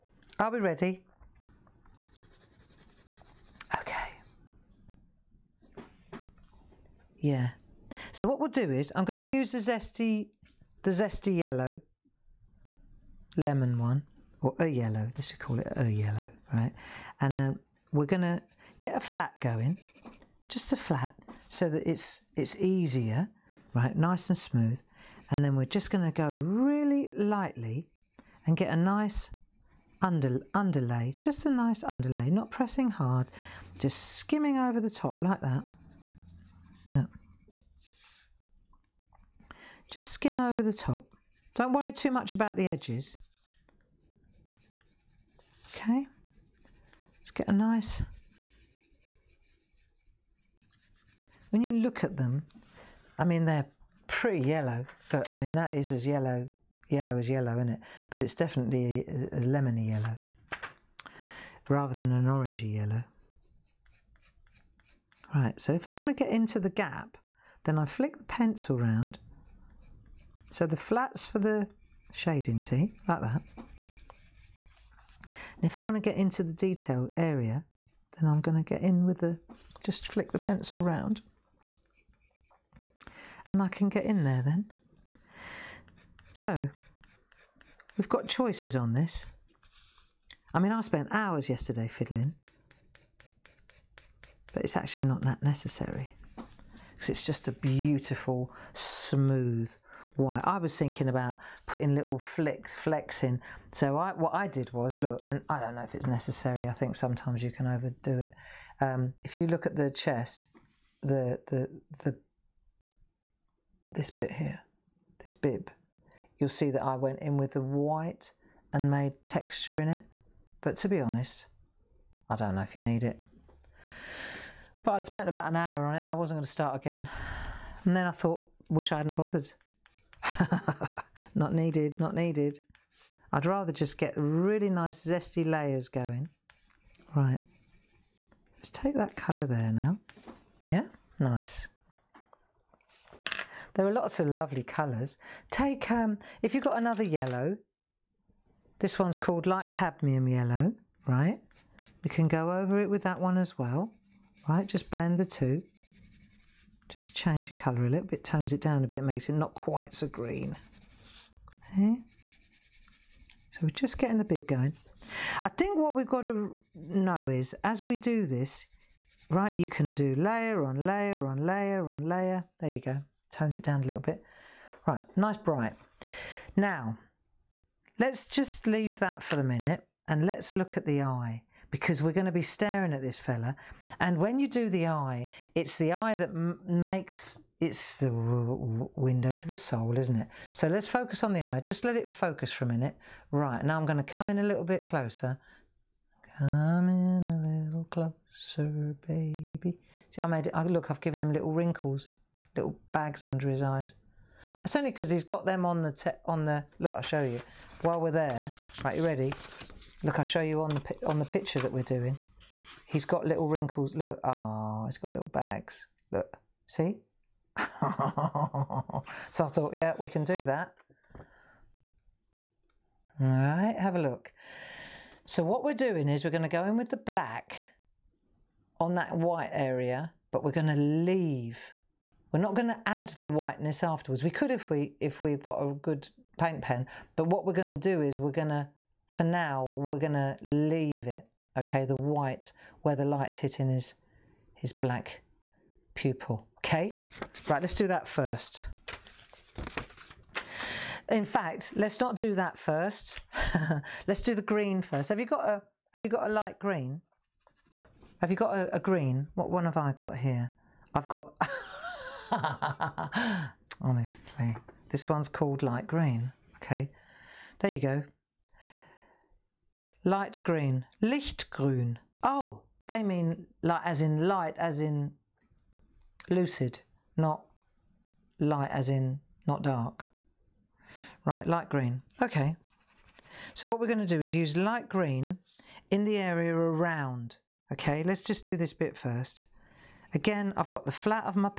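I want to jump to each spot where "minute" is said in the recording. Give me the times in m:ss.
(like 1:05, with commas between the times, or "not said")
2:59, 3:12.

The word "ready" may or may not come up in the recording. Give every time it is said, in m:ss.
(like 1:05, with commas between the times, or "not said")
0:00, 3:29.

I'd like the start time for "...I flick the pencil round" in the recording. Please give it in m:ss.
1:07.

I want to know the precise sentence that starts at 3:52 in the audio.
We're not going to add the whiteness afterwards.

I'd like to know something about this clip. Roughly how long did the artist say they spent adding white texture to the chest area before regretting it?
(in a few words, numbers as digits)
about an hour.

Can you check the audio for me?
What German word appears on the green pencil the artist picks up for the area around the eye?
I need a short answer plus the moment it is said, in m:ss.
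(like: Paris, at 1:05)
lichtgrün, at 4:31.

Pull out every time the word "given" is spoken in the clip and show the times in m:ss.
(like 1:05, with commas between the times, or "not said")
3:21.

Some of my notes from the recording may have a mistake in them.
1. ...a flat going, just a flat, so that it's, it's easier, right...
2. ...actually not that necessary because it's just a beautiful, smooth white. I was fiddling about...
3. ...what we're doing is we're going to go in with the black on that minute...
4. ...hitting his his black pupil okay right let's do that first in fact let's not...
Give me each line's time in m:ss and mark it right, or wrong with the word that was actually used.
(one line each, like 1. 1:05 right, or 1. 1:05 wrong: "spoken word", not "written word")
1. 0:18 right
2. 1:34 wrong: "thinking", not "fiddling"
3. 3:45 wrong: "white", not "minute"
4. 4:03 right.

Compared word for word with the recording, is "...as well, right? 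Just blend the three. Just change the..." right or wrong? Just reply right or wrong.
wrong.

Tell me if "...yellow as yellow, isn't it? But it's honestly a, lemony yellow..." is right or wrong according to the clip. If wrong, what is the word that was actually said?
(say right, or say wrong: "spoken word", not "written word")
wrong: "definitely", not "honestly".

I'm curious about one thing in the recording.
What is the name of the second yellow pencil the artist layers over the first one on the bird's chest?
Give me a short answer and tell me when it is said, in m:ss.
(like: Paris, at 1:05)
light cadmium yellow, at 2:29.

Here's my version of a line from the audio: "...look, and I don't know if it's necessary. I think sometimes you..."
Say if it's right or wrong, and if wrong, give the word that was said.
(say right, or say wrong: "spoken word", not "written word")
right.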